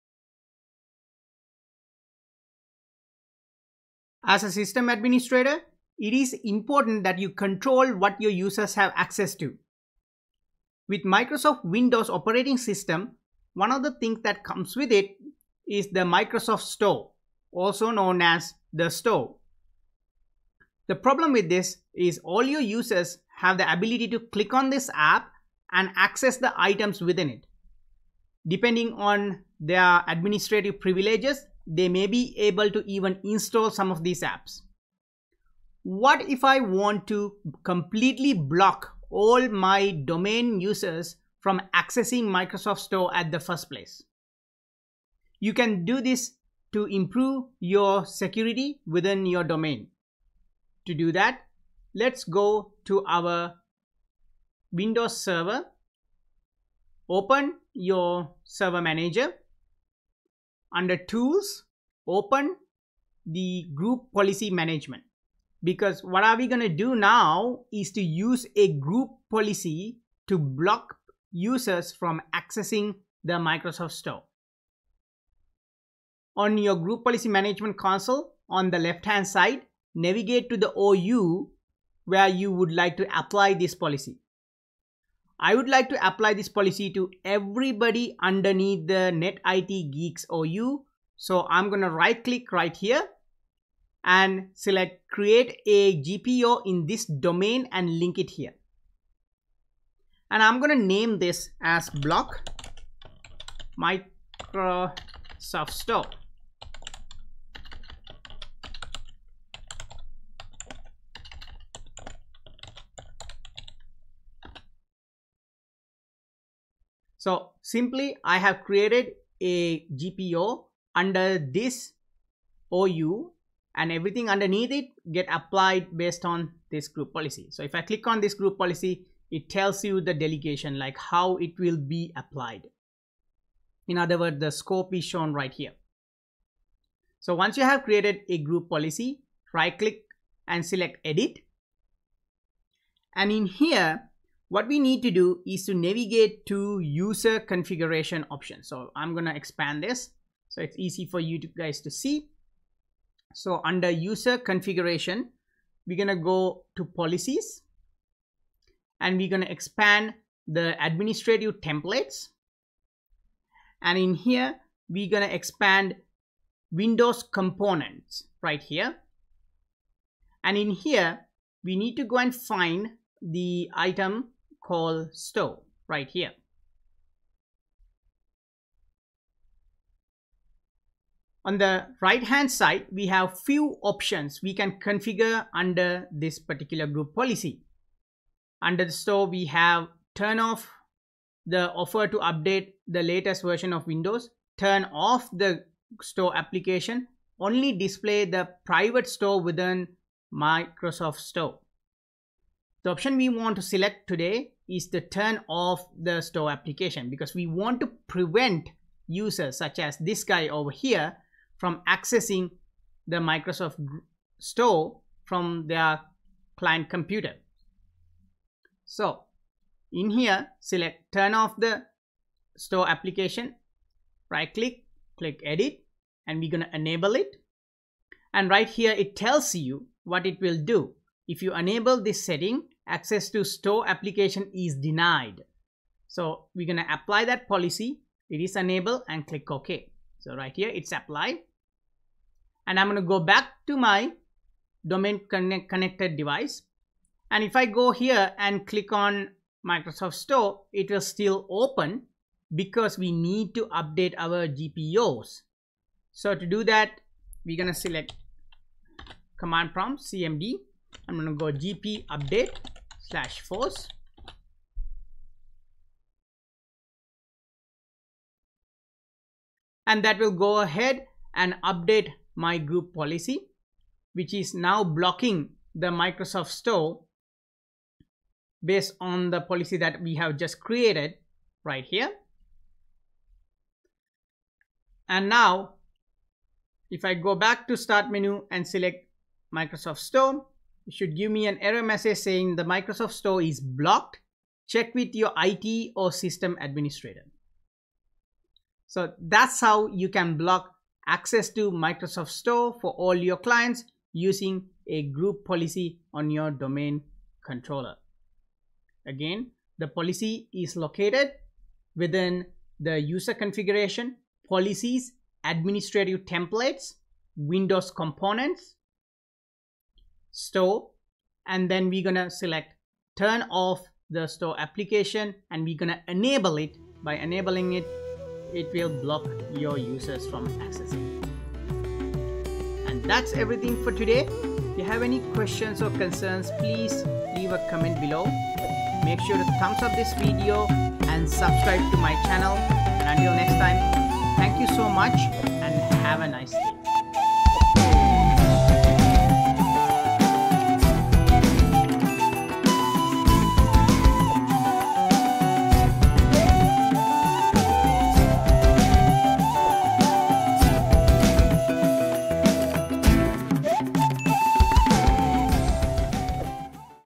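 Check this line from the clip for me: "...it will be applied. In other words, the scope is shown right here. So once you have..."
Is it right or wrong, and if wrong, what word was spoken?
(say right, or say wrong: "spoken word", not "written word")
right.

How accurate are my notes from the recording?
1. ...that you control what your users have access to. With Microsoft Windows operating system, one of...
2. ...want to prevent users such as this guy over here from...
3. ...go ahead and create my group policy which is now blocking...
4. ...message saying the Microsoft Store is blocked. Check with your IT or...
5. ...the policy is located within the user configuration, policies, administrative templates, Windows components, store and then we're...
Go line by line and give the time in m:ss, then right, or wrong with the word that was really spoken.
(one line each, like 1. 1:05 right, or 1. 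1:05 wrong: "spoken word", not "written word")
1. 0:07 right
2. 3:27 right
3. 4:30 wrong: "update", not "create"
4. 4:51 right
5. 5:09 right.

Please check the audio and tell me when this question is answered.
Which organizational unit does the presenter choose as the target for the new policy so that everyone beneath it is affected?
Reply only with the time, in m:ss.
1:29.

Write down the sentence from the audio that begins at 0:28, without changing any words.
Depending on their administrative privileges, they may be able to even install some of these apps.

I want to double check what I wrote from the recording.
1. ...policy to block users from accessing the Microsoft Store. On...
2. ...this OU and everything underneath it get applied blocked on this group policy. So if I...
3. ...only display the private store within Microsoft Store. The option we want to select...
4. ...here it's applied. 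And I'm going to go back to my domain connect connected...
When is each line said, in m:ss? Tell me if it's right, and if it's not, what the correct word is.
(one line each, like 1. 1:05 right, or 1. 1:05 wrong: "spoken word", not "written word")
1. 1:09 right
2. 2:01 wrong: "based", not "blocked"
3. 3:17 right
4. 4:00 right.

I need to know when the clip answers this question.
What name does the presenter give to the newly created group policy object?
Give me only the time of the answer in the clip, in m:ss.
1:41.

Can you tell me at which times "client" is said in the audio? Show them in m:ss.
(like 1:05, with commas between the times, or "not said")
3:36, 5:03.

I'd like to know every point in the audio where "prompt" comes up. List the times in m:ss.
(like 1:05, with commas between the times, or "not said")
4:19.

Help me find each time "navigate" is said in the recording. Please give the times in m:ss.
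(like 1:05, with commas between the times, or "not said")
1:19, 2:25.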